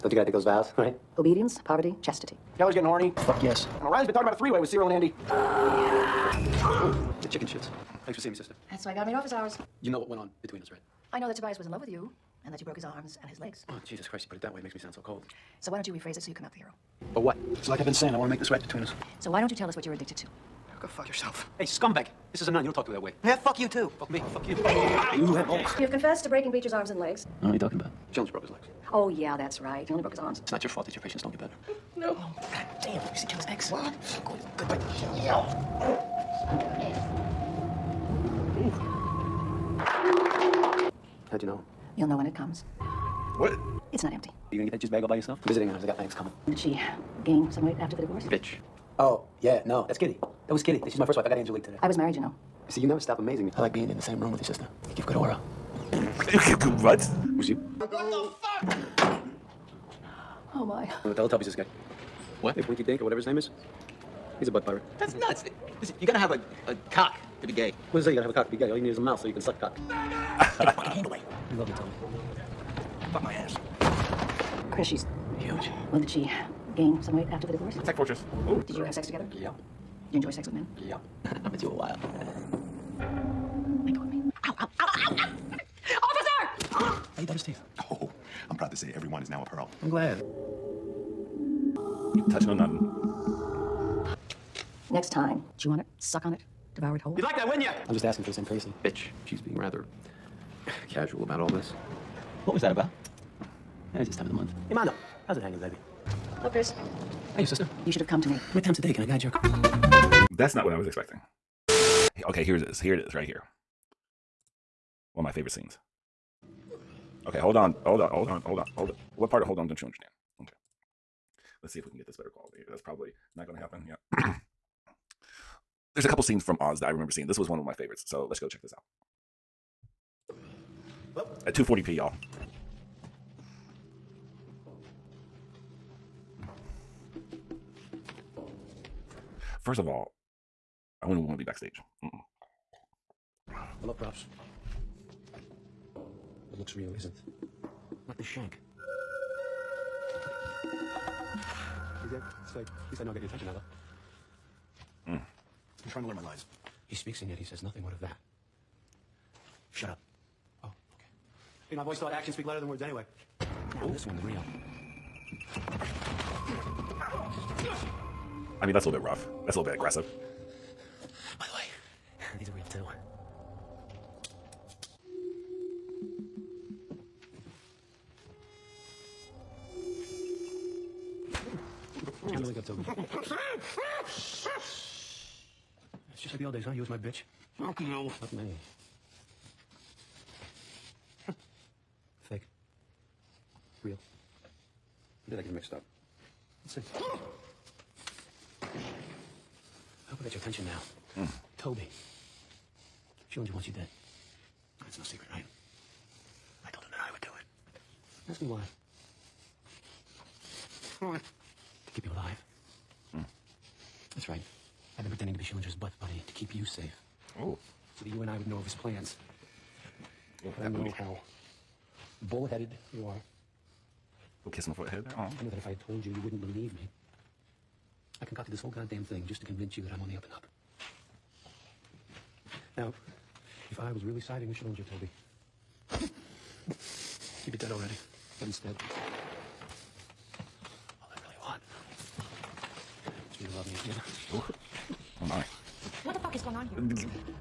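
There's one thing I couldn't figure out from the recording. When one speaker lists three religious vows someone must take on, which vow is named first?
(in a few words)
Obedience.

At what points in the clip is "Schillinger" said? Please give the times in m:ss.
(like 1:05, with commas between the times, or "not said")
0:28, 3:35, 3:54.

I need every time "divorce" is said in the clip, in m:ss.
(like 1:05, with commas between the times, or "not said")
0:48, 1:17.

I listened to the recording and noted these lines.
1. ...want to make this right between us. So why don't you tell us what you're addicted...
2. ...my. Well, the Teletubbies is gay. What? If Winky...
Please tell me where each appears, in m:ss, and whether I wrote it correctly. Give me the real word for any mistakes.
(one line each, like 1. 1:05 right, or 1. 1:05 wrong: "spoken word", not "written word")
1. 0:18 right
2. 1:00 right.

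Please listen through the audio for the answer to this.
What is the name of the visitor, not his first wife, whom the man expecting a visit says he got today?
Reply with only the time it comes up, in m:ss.
0:51.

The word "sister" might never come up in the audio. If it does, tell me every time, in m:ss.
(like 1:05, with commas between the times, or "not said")
0:08, 0:54, 1:47.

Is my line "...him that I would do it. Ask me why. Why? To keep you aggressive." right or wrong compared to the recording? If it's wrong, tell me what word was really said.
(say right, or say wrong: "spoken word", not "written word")
wrong: "alive", not "aggressive".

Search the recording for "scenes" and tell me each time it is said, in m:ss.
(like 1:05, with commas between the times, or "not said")
1:55, 2:06.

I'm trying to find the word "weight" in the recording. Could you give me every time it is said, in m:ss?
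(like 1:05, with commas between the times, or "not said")
0:47, 1:17.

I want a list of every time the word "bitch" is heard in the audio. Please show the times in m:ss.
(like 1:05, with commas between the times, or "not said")
0:48, 1:38, 3:06.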